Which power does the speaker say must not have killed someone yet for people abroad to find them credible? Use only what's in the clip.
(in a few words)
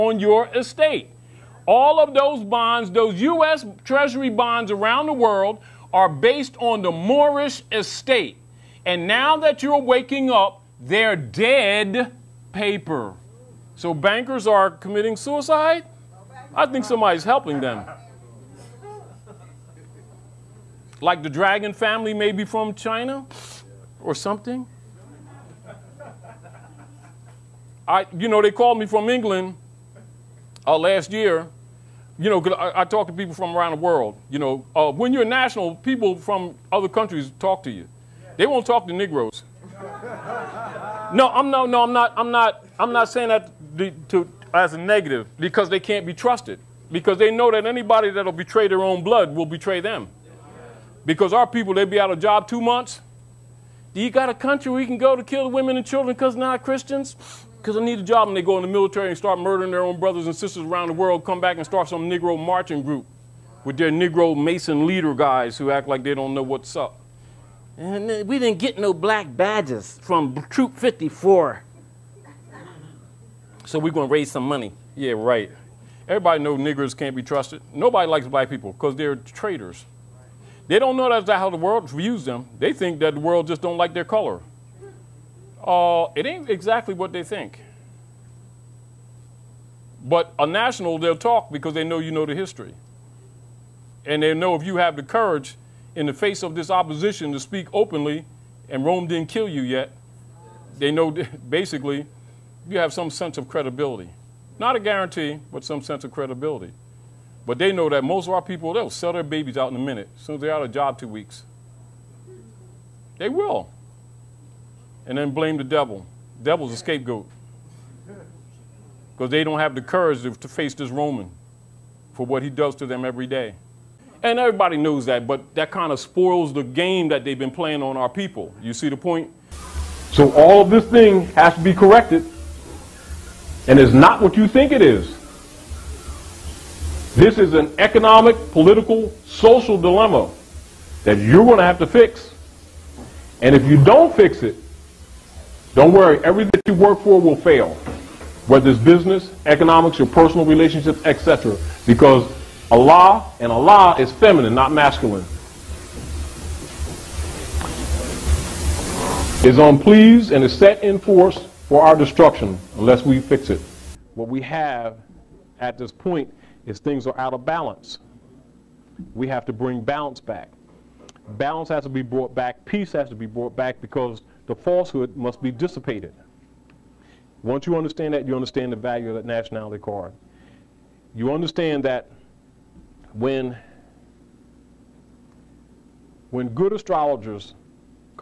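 Rome.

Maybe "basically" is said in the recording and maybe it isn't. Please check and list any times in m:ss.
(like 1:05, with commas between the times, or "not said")
1:41.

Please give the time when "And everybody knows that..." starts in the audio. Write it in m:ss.
2:04.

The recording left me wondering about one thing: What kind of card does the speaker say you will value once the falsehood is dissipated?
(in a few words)
nationality card.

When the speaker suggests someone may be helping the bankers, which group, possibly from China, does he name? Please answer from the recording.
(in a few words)
the dragon family.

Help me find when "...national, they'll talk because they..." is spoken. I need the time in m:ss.
1:30.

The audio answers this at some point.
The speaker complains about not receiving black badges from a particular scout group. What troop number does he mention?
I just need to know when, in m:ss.
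1:10.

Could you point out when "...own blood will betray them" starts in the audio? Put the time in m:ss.
0:48.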